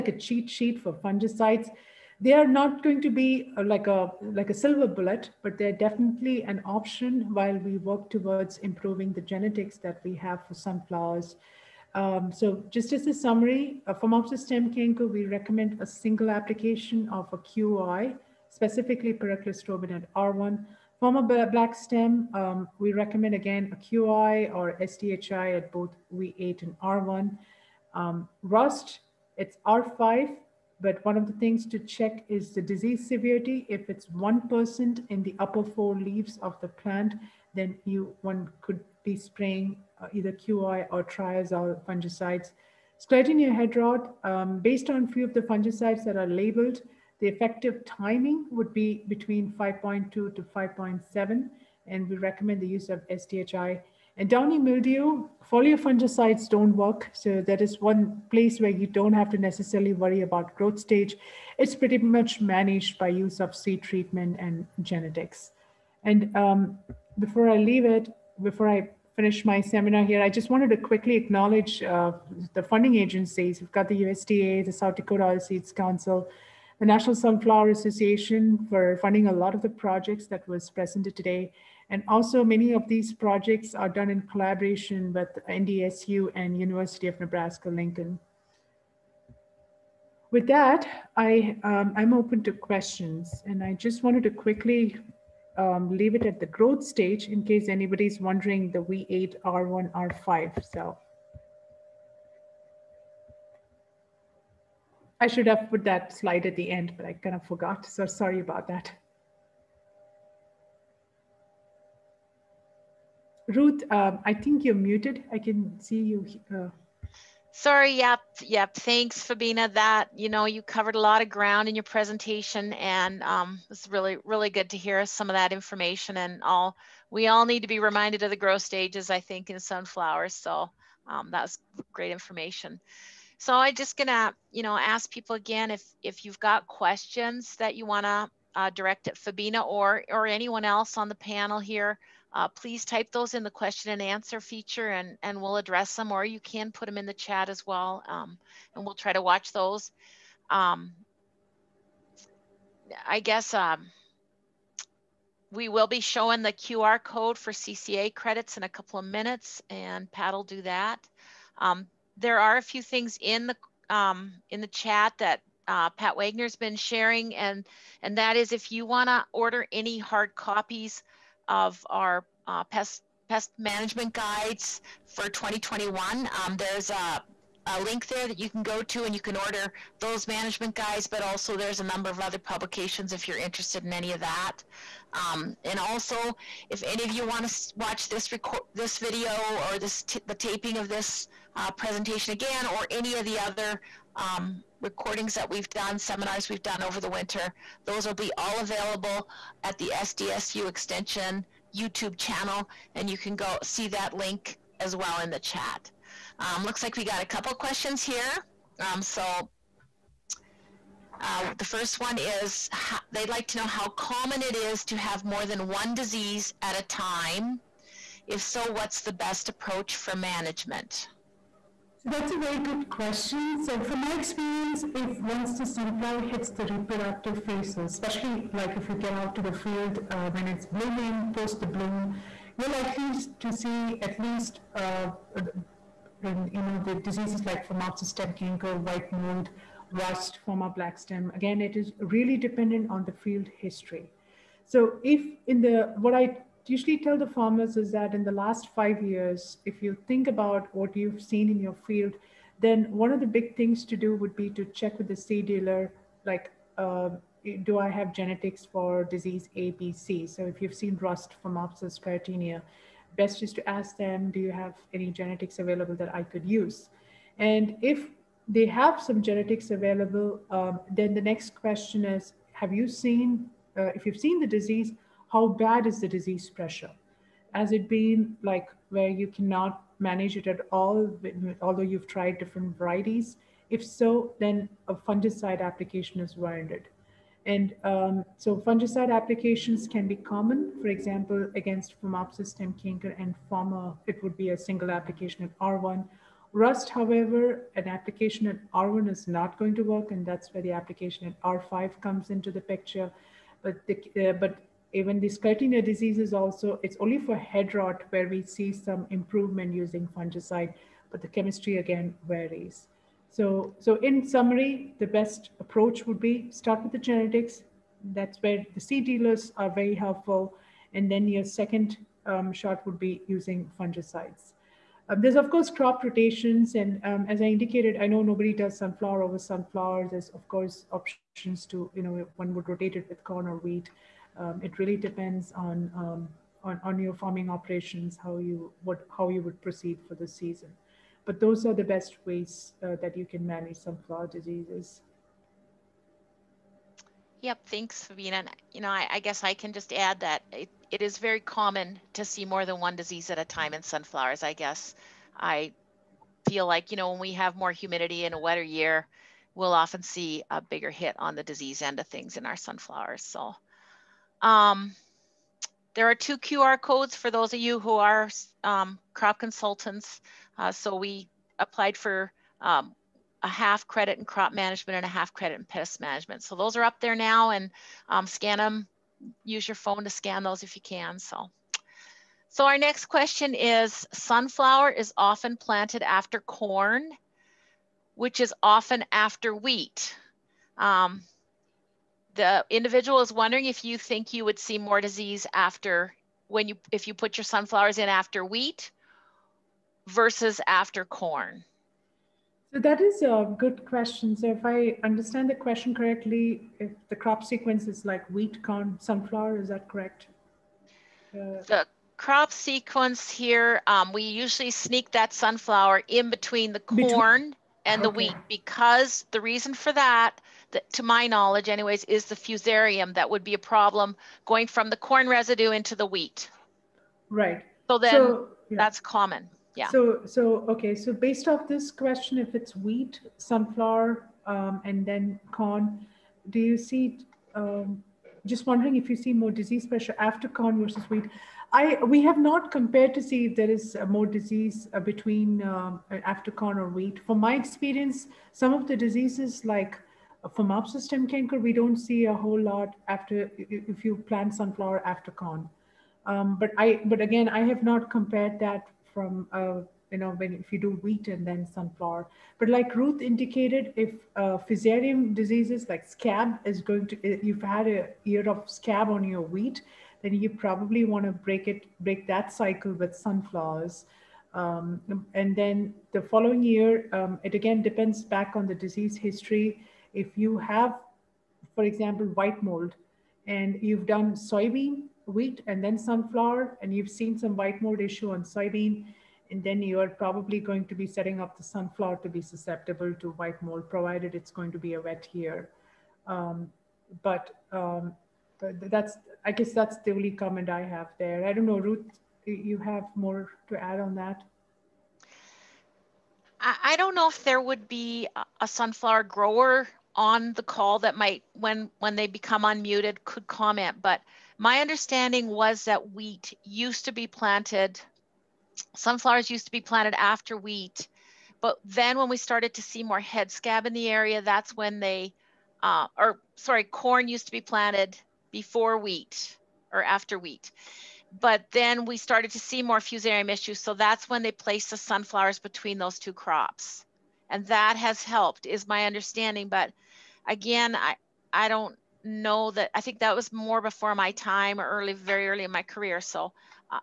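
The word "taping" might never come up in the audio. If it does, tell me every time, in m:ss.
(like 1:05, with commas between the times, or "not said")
3:10.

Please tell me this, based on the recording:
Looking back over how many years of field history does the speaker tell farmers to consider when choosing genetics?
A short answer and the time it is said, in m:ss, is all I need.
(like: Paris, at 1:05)
5, at 4:08.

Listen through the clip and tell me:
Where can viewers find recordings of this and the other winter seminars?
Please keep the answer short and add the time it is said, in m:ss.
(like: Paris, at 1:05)
SDSU Extension YouTube channel, at 3:19.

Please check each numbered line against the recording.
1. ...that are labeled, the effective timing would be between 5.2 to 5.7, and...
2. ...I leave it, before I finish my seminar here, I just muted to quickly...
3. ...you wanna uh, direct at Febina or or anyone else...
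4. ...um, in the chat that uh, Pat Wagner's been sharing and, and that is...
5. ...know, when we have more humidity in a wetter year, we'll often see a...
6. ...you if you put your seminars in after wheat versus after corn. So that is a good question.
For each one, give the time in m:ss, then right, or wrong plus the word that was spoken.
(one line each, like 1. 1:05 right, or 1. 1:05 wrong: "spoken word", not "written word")
1. 0:46 right
2. 1:07 wrong: "wanted", not "muted"
3. 2:17 right
4. 2:43 right
5. 5:56 right
6. 6:36 wrong: "sunflowers", not "seminars".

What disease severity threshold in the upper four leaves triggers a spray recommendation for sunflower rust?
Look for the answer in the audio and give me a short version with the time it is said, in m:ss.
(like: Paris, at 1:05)
1%, at 0:34.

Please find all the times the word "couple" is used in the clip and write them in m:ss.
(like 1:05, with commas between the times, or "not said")
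2:38, 3:27.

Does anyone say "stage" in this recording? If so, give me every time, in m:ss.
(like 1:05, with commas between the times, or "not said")
1:00, 1:36, 2:08.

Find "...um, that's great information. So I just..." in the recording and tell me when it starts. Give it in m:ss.
2:11.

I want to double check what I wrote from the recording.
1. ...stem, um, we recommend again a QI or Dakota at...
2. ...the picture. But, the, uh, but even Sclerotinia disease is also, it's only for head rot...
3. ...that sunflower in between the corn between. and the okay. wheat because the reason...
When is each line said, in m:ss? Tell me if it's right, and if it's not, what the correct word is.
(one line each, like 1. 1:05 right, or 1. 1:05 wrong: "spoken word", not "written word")
1. 0:21 wrong: "SDHI", not "Dakota"
2. 5:02 right
3. 6:55 right.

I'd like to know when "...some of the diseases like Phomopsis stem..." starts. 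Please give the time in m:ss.
7:28.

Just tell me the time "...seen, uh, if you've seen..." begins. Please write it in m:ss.
4:32.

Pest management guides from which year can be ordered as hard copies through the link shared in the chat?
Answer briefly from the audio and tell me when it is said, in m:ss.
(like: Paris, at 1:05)
2021, at 2:55.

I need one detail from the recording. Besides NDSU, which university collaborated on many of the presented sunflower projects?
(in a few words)
University of Nebraska-Lincoln.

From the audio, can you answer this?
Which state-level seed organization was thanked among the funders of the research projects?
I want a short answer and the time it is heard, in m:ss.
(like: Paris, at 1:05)
South Dakota Seeds Council, at 1:14.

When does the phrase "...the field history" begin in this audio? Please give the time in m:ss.
4:03.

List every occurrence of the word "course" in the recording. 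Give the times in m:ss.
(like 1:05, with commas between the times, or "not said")
5:25, 5:30.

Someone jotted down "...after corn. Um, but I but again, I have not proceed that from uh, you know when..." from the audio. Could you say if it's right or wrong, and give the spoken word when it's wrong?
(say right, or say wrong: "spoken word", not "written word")
wrong: "compared", not "proceed".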